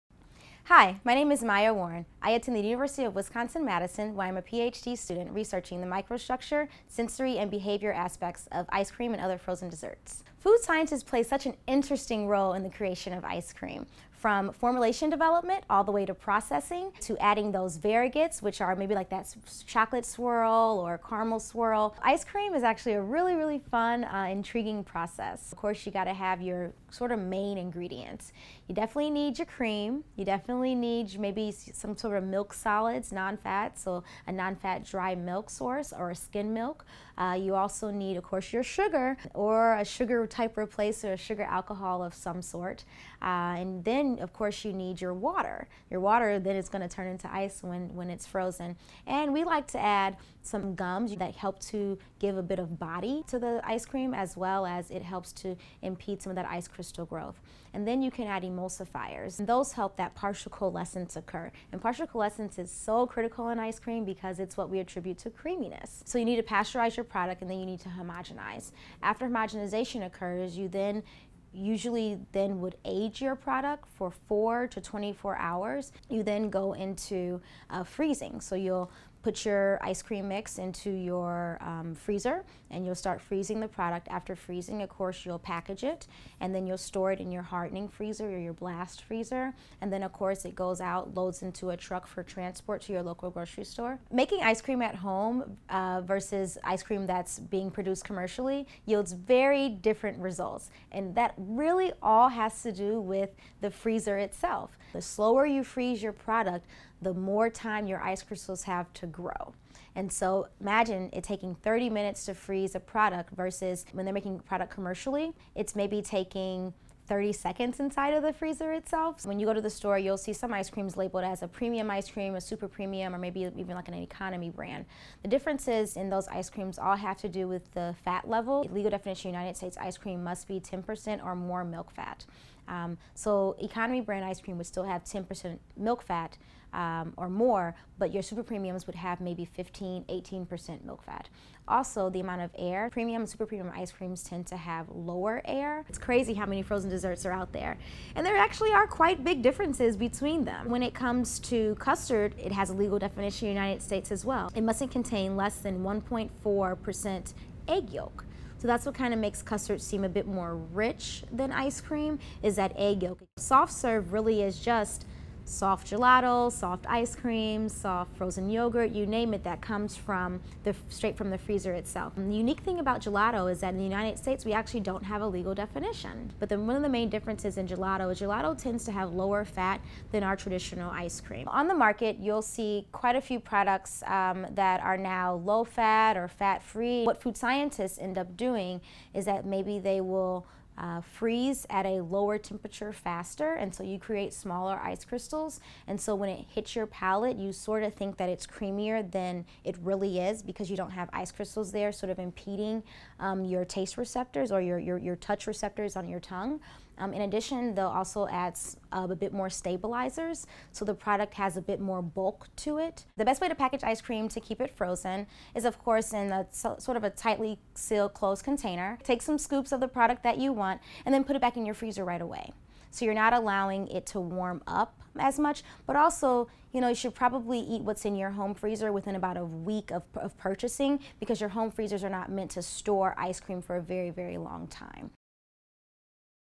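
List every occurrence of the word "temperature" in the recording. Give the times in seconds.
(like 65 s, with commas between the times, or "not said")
192 s.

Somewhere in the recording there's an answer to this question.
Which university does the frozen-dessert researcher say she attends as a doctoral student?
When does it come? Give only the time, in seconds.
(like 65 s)
2 s.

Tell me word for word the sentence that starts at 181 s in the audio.
On the market you'll see quite a few products um, that are now low fat or fat free.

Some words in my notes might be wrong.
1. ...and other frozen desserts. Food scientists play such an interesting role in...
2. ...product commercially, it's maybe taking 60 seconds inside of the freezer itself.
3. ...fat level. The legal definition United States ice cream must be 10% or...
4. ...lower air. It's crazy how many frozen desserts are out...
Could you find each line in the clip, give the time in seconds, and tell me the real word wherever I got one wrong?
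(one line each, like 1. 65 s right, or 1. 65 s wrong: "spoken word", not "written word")
1. 9 s right
2. 114 s wrong: "30", not "60"
3. 128 s right
4. 144 s right.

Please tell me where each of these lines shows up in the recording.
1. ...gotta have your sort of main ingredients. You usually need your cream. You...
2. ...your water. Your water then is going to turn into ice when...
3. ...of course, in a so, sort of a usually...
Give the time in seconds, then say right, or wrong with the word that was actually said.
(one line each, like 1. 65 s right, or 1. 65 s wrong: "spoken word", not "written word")
1. 25 s wrong: "definitely", not "usually"
2. 44 s right
3. 215 s wrong: "tightly", not "usually".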